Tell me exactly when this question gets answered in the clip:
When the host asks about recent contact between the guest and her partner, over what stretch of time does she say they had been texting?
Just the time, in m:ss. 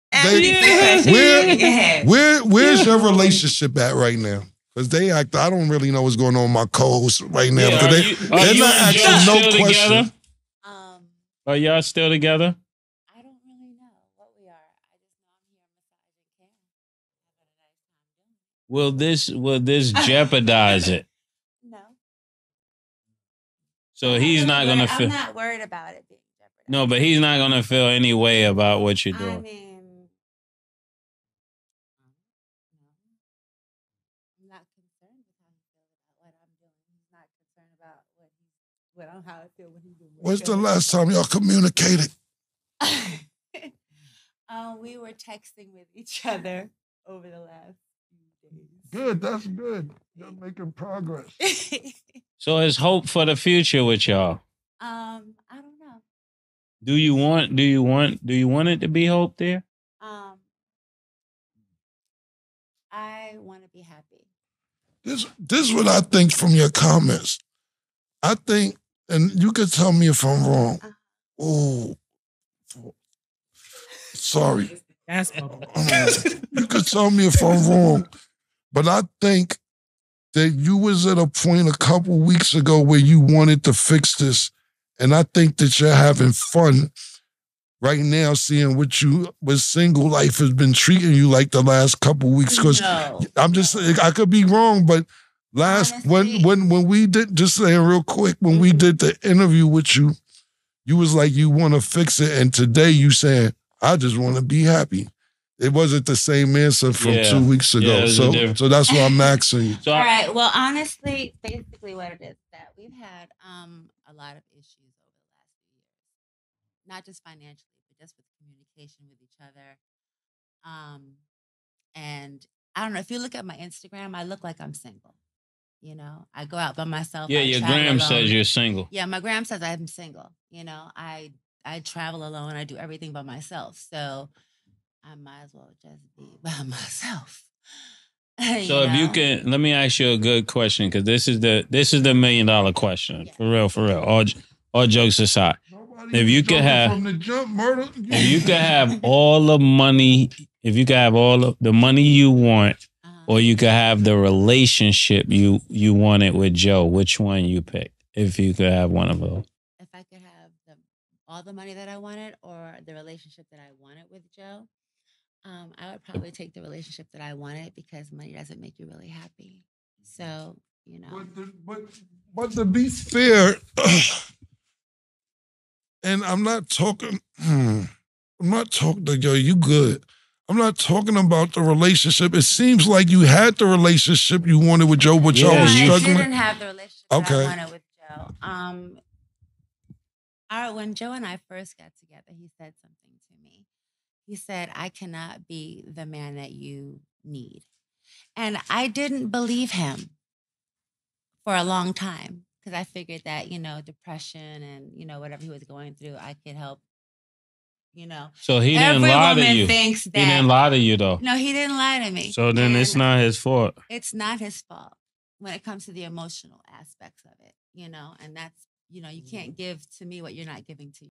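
0:47.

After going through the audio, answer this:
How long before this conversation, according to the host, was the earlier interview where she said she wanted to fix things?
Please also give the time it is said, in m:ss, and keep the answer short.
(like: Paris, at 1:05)
two weeks ago, at 1:47.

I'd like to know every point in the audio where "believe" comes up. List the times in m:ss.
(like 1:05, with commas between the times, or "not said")
3:19.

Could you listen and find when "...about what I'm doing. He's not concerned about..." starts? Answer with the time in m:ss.
0:36.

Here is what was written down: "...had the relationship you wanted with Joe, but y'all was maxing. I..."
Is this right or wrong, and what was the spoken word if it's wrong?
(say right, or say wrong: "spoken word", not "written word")
wrong: "struggling", not "maxing".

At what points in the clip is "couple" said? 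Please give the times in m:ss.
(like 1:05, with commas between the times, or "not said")
1:21, 1:31.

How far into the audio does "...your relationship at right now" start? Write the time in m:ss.
0:02.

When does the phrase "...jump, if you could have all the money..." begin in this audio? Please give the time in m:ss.
2:27.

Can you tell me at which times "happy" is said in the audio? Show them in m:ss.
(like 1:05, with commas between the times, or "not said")
1:03, 1:44, 2:49.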